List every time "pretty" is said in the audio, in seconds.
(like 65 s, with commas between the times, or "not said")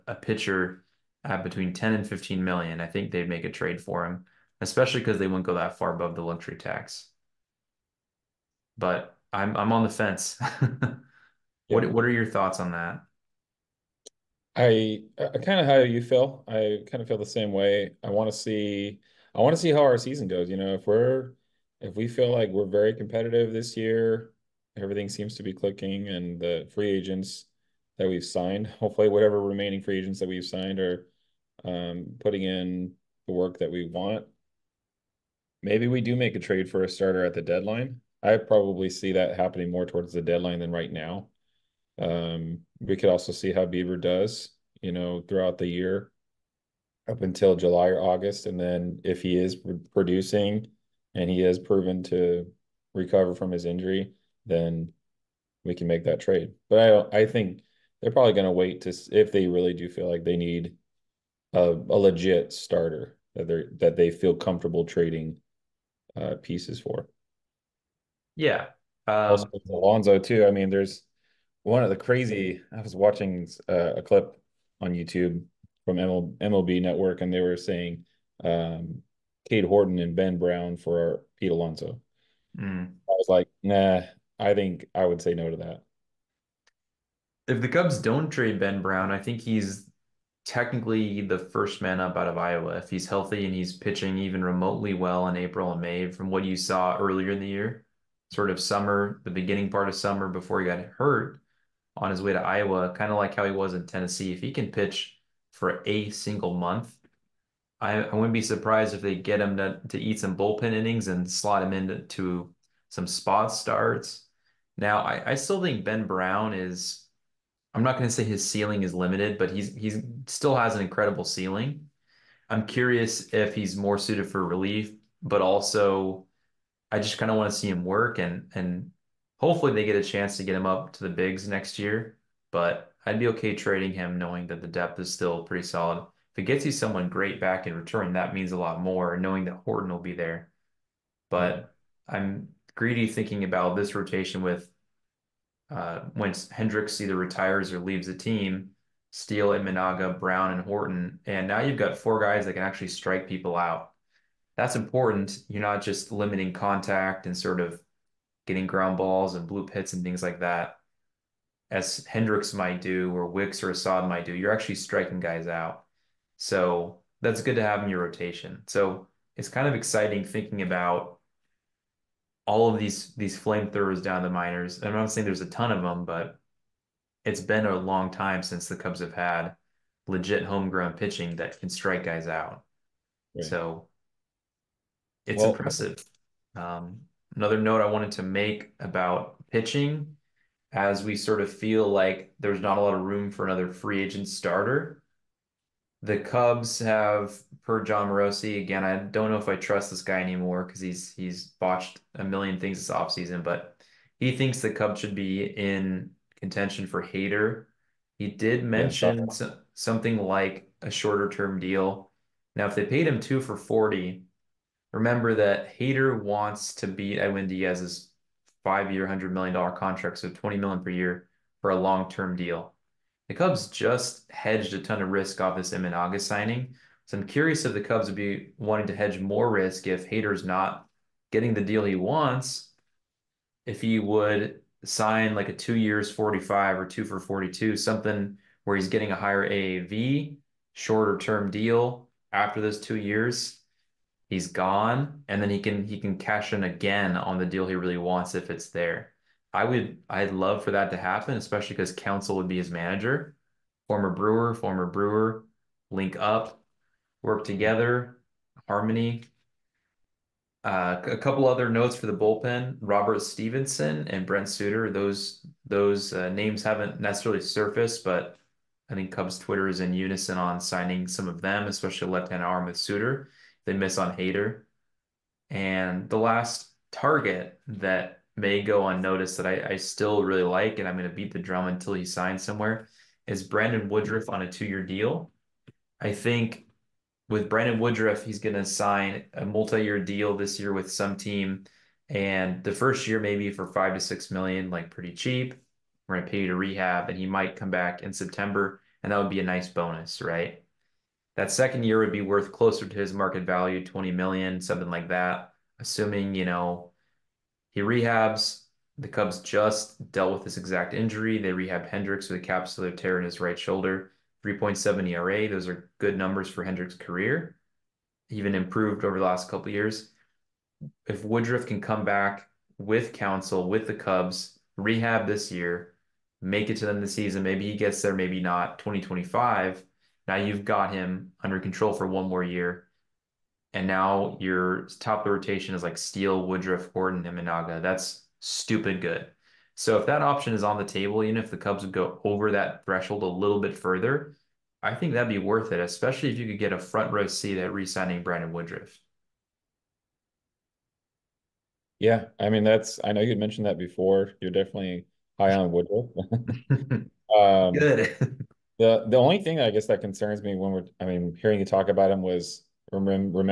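135 s, 294 s.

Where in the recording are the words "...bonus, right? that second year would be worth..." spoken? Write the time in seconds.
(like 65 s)
299 s.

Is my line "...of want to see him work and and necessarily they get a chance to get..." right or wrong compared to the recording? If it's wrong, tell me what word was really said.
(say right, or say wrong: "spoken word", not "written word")
wrong: "hopefully", not "necessarily".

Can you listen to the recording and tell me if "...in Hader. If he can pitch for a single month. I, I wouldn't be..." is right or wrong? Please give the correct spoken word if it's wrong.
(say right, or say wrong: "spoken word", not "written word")
wrong: "Tennessee", not "Hader".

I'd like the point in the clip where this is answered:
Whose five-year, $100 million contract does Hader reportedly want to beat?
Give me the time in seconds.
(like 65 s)
217 s.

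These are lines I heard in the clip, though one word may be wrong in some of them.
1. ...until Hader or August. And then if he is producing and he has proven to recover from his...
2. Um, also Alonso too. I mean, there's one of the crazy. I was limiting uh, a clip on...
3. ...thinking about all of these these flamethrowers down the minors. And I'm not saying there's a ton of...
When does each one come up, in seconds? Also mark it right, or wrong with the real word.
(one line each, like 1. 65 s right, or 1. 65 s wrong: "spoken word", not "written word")
1. 47 s wrong: "July", not "Hader"
2. 69 s wrong: "watching", not "limiting"
3. 170 s right.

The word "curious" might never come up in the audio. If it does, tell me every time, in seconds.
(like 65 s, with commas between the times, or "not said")
122 s, 227 s.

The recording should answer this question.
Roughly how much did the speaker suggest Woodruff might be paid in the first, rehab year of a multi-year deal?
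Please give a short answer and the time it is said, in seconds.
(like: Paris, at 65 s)
5 to 6 million, at 293 s.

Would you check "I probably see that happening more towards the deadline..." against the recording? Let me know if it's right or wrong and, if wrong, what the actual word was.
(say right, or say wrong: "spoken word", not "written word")
right.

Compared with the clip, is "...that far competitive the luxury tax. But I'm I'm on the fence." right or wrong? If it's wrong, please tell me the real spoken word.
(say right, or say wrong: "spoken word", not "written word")
wrong: "above", not "competitive".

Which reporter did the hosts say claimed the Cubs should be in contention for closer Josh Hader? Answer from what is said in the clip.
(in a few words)
Jon Morosi.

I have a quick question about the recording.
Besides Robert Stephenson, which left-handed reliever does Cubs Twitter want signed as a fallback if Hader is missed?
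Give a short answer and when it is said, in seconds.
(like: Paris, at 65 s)
Brent Suter, at 264 s.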